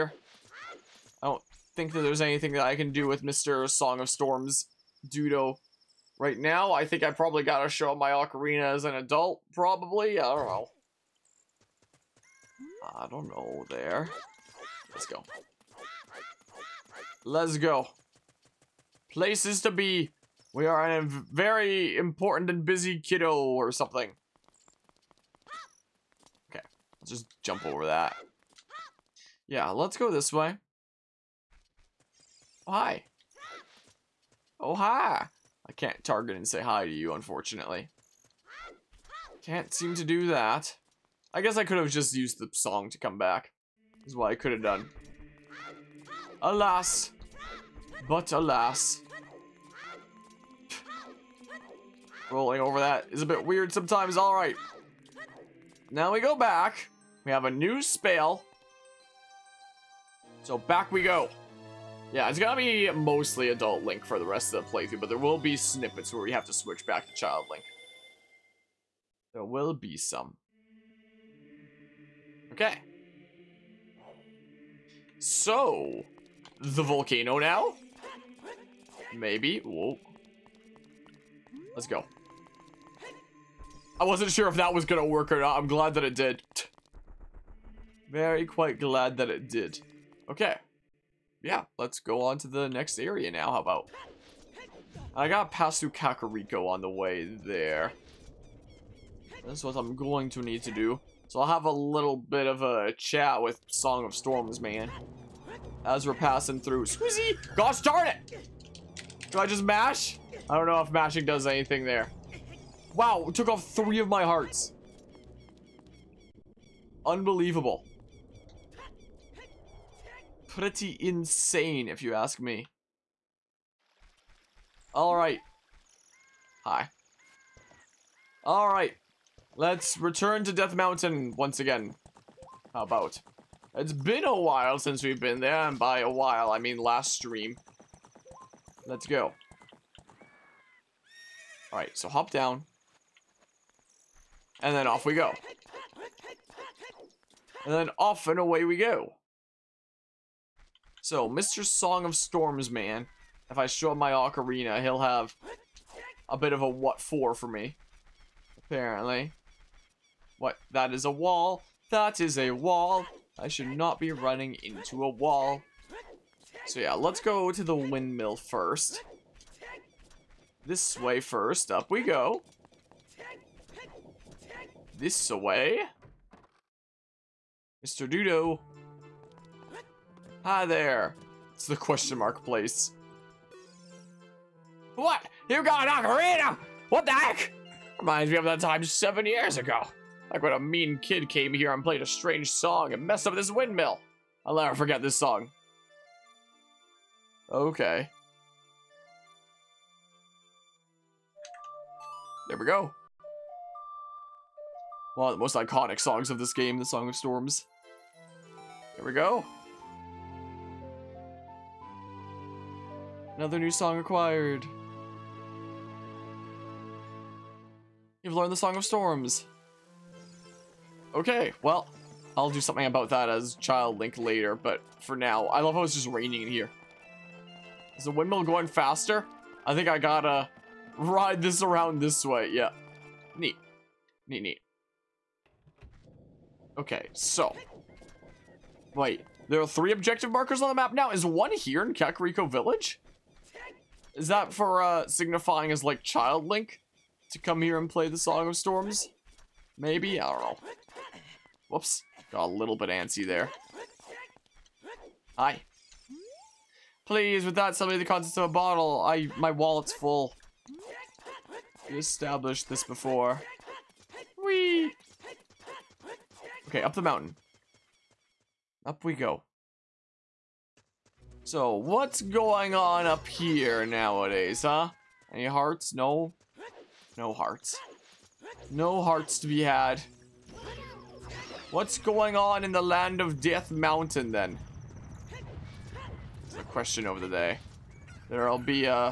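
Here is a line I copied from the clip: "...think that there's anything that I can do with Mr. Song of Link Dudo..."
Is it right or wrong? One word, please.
wrong.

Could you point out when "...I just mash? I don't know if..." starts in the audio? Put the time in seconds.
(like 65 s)
109 s.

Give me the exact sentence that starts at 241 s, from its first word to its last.
Is one here in Kakariko Village?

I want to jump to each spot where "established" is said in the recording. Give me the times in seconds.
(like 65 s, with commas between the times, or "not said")
261 s.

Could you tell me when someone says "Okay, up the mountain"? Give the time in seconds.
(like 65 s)
266 s.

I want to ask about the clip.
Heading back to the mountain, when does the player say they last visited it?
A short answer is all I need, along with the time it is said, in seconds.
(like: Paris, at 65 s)
Last stream, at 136 s.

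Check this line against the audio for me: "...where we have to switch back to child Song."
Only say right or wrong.
wrong.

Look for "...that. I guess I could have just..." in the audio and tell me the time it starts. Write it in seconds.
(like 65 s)
40 s.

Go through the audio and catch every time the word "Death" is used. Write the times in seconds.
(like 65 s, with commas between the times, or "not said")
130 s, 283 s.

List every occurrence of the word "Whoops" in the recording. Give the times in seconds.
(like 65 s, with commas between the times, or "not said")
251 s.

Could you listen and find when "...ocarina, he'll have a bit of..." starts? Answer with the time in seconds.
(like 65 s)
154 s.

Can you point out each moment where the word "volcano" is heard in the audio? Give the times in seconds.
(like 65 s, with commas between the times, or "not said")
76 s.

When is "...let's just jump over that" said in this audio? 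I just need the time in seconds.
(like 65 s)
27 s.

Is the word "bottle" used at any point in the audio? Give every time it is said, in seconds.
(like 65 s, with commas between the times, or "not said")
258 s.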